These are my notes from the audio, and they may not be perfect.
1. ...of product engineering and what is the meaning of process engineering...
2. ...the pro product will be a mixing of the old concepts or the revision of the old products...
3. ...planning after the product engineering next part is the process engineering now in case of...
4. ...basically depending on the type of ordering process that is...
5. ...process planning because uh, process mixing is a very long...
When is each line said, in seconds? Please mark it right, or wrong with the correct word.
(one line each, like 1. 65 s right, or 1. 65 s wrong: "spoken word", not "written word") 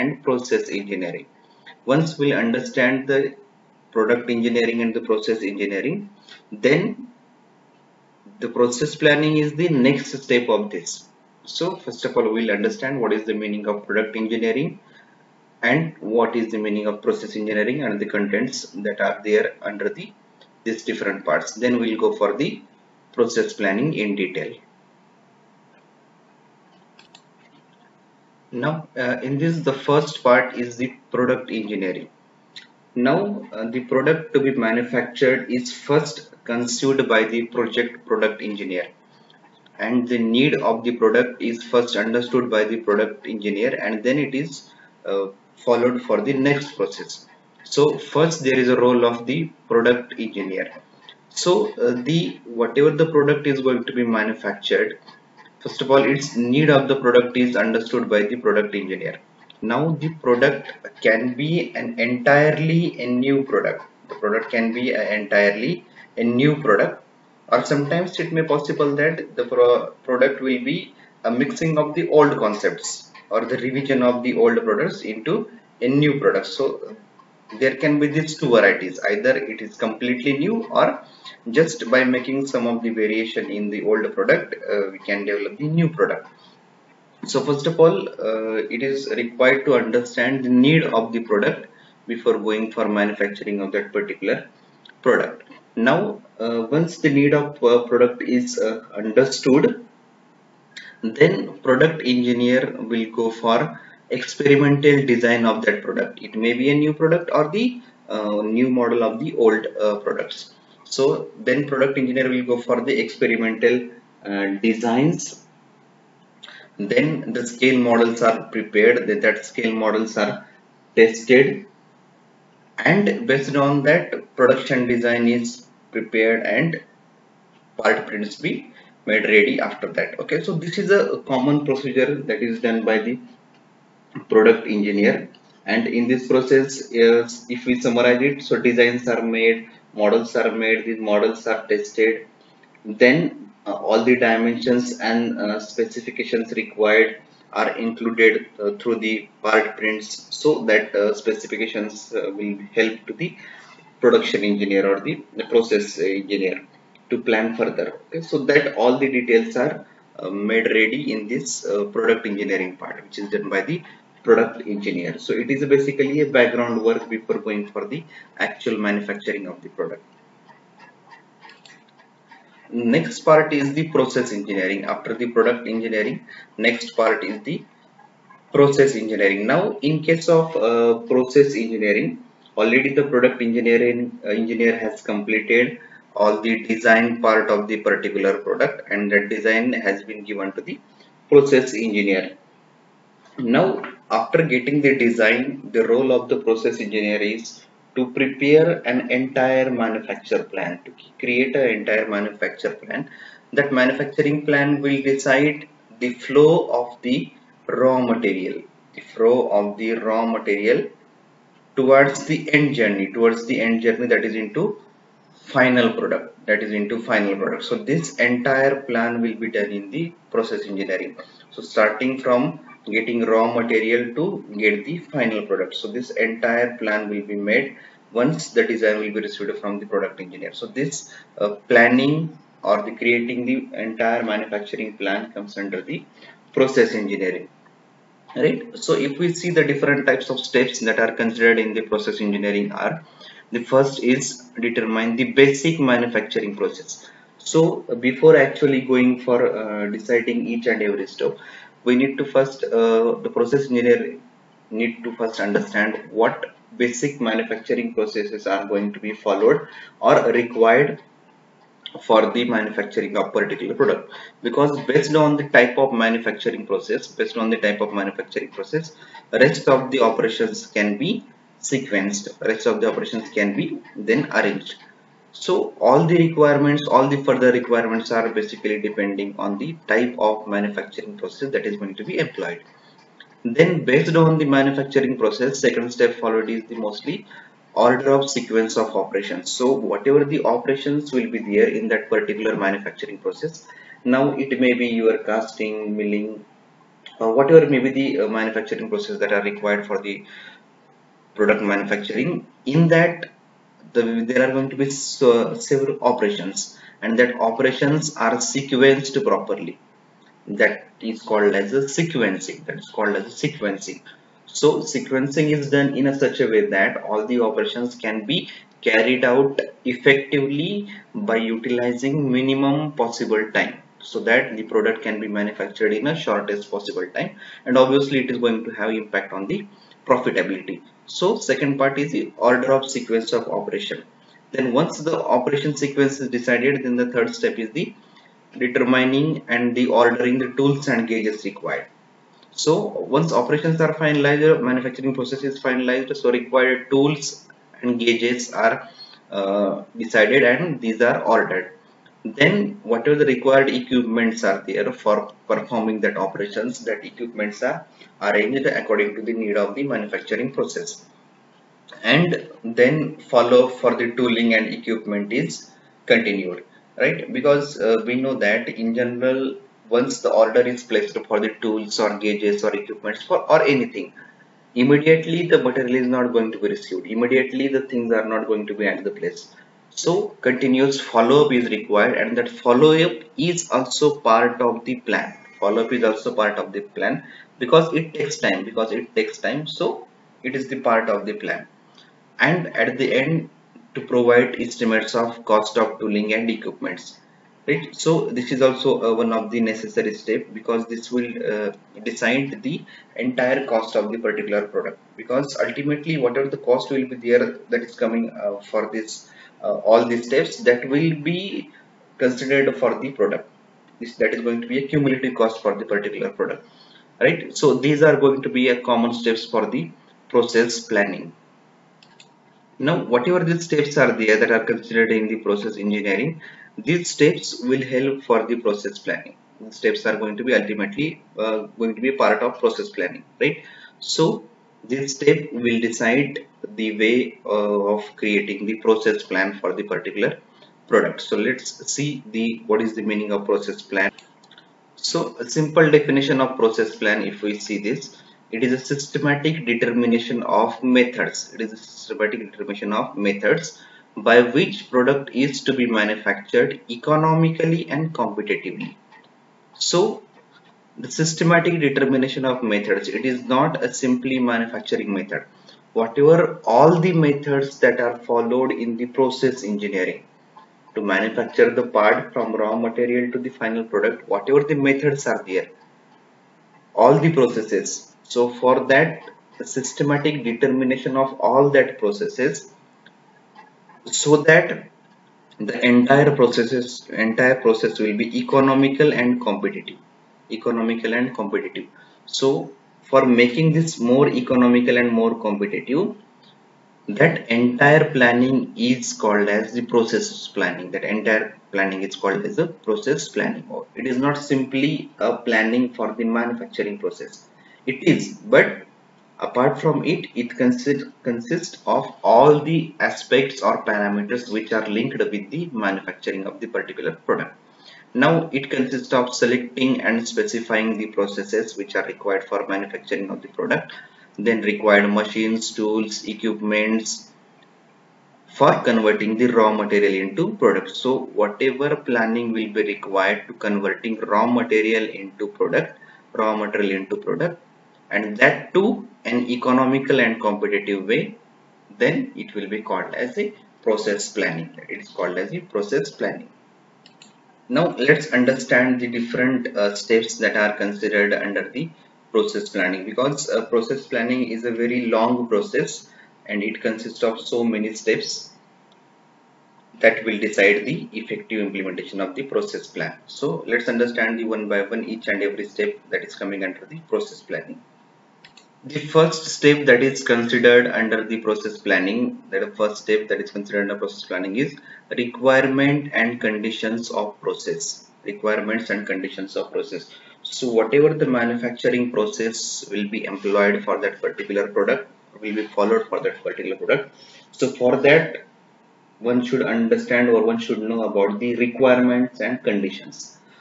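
1. 13 s right
2. 69 s right
3. 174 s wrong: "engineering", not "planning"
4. 278 s wrong: "manufacturing", not "ordering"
5. 552 s wrong: "planning", not "mixing".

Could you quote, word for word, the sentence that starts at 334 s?
Then once the operation sequence is decided, then the third step is the determining and the ordering the tools and gauges required.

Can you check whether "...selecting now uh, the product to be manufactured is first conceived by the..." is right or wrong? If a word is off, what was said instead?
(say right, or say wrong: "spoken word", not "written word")
wrong: "engineering", not "selecting".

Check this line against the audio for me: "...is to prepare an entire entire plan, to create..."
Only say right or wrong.
wrong.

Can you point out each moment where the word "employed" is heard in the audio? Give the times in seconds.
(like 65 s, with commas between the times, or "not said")
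282 s, 583 s.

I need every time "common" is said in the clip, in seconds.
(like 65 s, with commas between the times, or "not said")
131 s, 418 s.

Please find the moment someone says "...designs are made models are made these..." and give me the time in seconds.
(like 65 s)
138 s.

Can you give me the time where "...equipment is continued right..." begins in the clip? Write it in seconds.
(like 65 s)
364 s.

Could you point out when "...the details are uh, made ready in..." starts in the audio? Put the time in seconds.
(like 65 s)
159 s.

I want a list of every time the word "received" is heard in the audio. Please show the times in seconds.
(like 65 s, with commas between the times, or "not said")
229 s, 376 s.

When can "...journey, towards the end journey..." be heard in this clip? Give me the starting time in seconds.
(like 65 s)
212 s.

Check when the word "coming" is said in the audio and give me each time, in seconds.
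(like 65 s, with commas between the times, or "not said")
407 s, 566 s.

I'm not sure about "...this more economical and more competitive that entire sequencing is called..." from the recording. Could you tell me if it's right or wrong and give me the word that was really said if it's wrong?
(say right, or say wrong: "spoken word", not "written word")
wrong: "planning", not "sequencing".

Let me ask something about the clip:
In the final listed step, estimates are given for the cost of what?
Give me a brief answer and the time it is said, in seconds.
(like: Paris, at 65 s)
Tooling and equipments, at 395 s.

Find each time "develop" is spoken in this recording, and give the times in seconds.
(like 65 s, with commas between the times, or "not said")
85 s.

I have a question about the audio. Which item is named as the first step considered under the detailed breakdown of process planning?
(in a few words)
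Requirements and conditions of process.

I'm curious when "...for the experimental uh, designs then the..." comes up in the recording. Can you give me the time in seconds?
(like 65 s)
112 s.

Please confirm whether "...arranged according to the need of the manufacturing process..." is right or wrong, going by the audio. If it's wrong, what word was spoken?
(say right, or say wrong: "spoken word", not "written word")
right.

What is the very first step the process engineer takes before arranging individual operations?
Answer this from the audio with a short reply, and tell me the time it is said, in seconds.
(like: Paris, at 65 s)
Determine the basic manufacturing process, at 244 s.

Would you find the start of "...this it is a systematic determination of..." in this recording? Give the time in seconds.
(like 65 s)
447 s.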